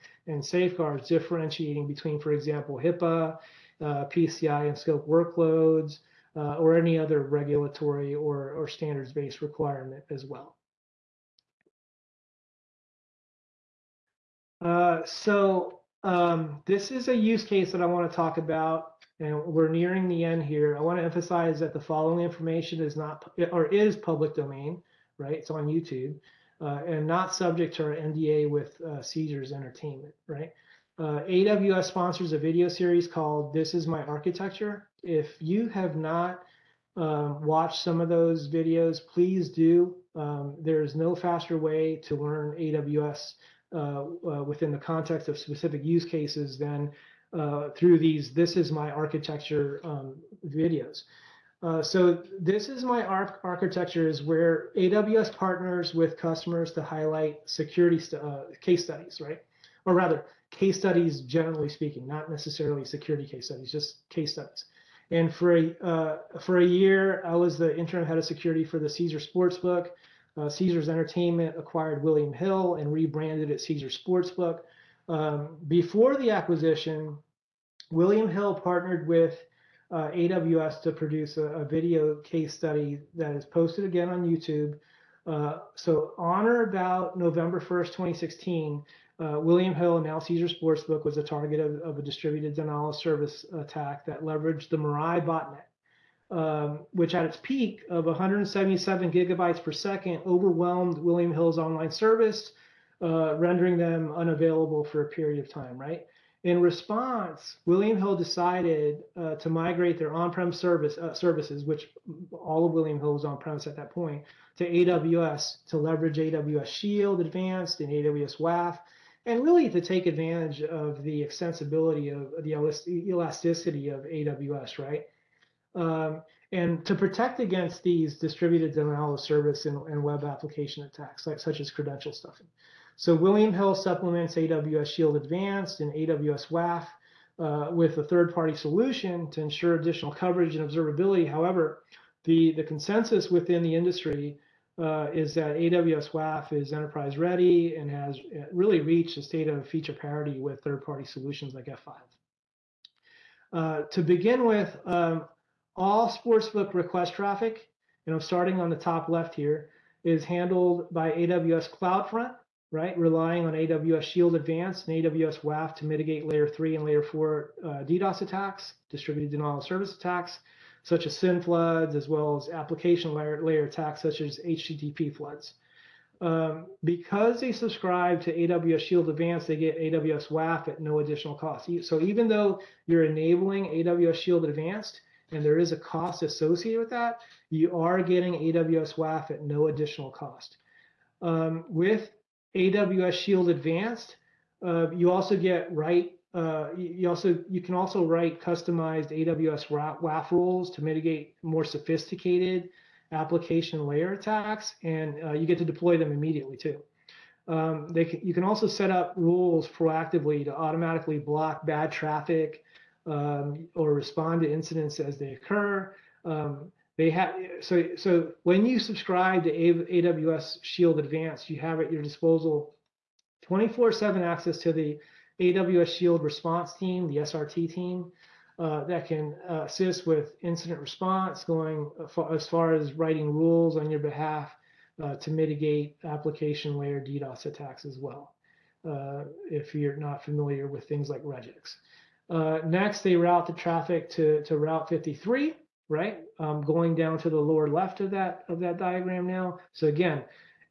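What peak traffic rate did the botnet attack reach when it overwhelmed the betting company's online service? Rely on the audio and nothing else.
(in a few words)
177 gigabytes per second.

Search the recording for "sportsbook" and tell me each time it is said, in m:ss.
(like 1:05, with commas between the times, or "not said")
1:09, 1:13, 1:30, 2:36.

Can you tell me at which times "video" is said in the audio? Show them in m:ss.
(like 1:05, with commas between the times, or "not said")
0:32, 0:38, 0:50, 1:21.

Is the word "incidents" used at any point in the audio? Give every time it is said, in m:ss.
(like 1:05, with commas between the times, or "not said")
3:34, 3:50.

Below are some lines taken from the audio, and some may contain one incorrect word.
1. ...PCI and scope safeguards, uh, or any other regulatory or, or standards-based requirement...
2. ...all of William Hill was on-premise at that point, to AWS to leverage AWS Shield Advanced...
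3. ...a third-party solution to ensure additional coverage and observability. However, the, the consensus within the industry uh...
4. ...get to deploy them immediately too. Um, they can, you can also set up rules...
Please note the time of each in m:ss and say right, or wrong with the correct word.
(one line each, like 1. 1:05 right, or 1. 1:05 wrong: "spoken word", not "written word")
1. 0:04 wrong: "workloads", not "safeguards"
2. 1:52 right
3. 2:17 right
4. 3:25 right.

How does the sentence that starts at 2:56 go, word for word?
Um, because they subscribe to AWS Shield Advanced, they get AWS WAF at no additional cost.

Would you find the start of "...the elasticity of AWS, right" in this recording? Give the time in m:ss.
2:02.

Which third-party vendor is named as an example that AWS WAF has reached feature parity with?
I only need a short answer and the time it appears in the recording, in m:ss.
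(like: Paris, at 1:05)
F5, at 2:31.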